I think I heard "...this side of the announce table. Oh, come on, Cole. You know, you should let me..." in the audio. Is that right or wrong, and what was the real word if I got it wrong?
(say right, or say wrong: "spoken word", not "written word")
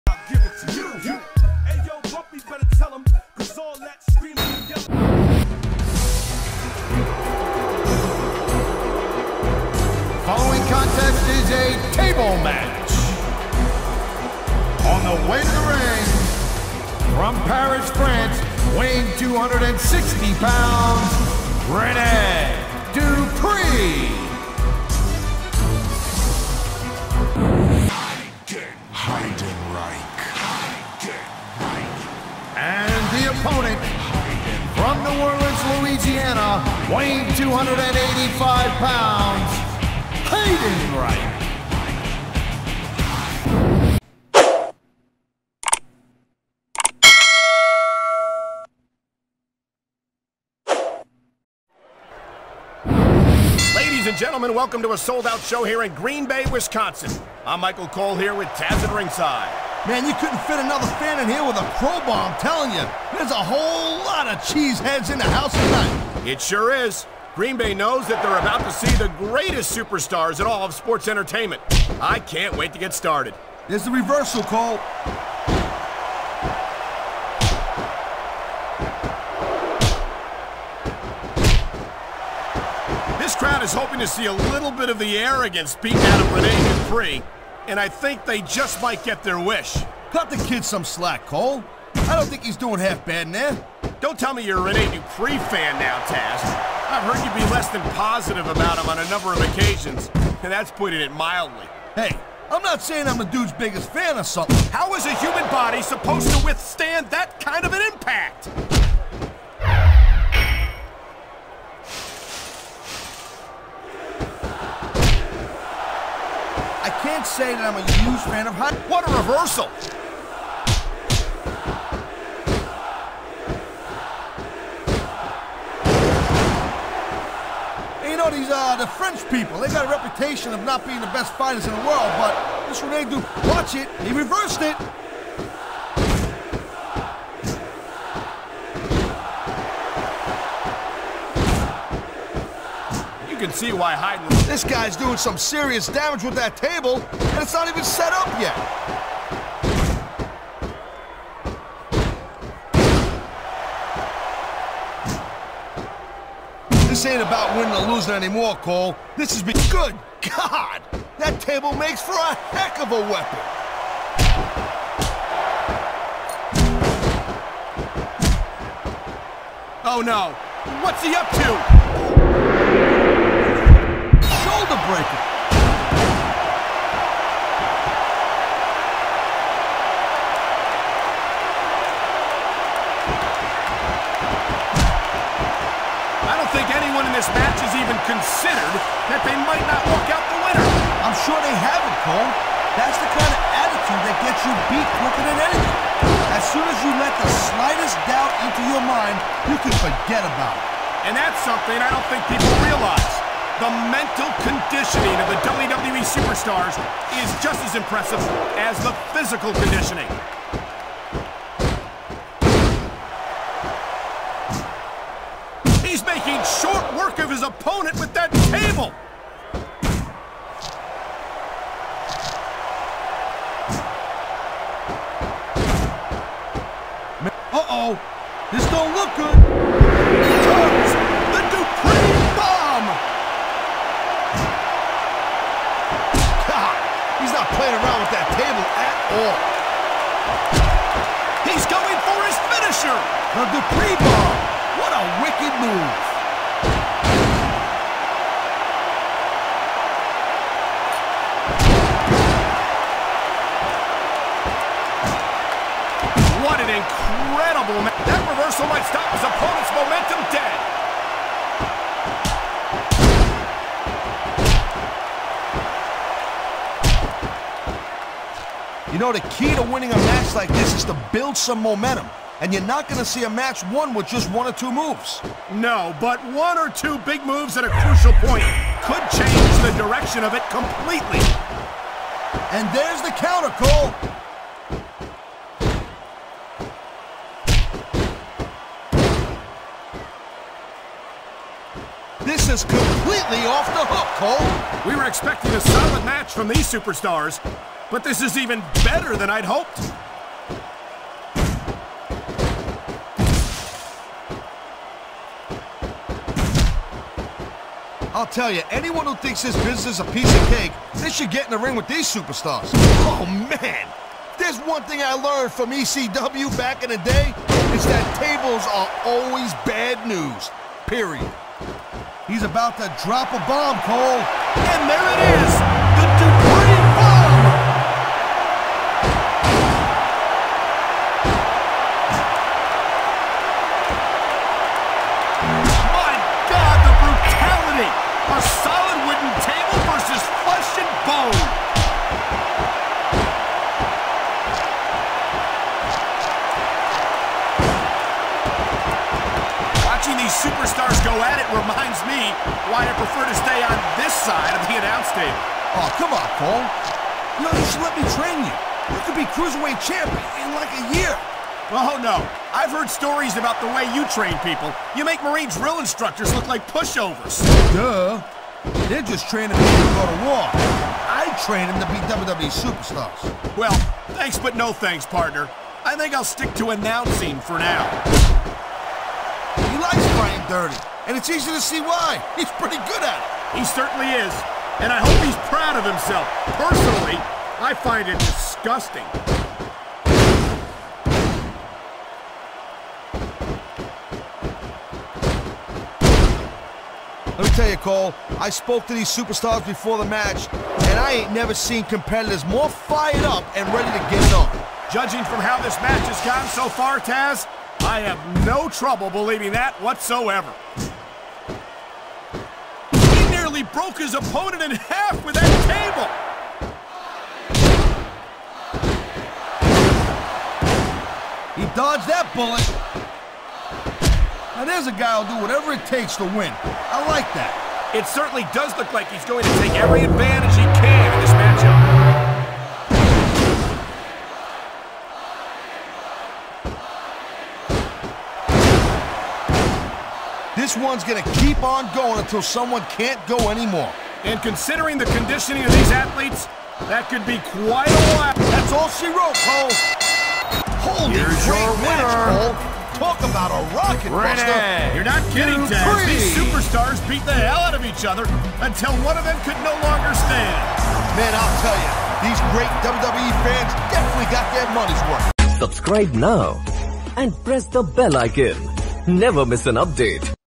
right.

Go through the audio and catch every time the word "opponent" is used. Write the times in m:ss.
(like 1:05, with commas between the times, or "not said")
3:37, 4:19, 6:54.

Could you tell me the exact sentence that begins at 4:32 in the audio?
And you're not going to see a match won with just one or two moves.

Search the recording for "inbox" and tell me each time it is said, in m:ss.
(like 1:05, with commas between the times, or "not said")
not said.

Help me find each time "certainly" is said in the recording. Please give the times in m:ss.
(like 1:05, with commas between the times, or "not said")
6:23, 7:08.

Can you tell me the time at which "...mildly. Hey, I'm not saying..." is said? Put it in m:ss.
1:41.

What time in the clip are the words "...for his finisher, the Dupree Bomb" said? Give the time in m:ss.
4:02.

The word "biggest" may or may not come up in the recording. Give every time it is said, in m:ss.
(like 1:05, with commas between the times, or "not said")
1:43.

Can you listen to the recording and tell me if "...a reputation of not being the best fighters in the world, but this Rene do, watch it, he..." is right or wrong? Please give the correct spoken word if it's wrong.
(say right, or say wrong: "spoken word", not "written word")
right.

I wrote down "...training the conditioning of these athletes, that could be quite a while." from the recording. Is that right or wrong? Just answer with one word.
wrong.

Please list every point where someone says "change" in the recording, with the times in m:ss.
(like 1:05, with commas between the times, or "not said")
4:39.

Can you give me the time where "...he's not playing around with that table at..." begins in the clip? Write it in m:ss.
3:57.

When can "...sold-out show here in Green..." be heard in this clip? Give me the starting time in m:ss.
0:54.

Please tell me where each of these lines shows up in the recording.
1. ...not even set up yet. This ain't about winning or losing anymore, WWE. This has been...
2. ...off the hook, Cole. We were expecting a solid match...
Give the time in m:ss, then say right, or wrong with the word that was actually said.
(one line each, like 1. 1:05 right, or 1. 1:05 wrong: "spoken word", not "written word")
1. 2:27 wrong: "Cole", not "WWE"
2. 4:53 right.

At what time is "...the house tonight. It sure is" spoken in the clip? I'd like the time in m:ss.
1:05.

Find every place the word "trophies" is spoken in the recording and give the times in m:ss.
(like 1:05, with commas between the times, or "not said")
not said.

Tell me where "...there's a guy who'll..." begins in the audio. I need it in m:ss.
7:04.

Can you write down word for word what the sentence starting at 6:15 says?
I think I'll stick to announcing for now.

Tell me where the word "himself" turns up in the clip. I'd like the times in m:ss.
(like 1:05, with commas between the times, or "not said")
6:25.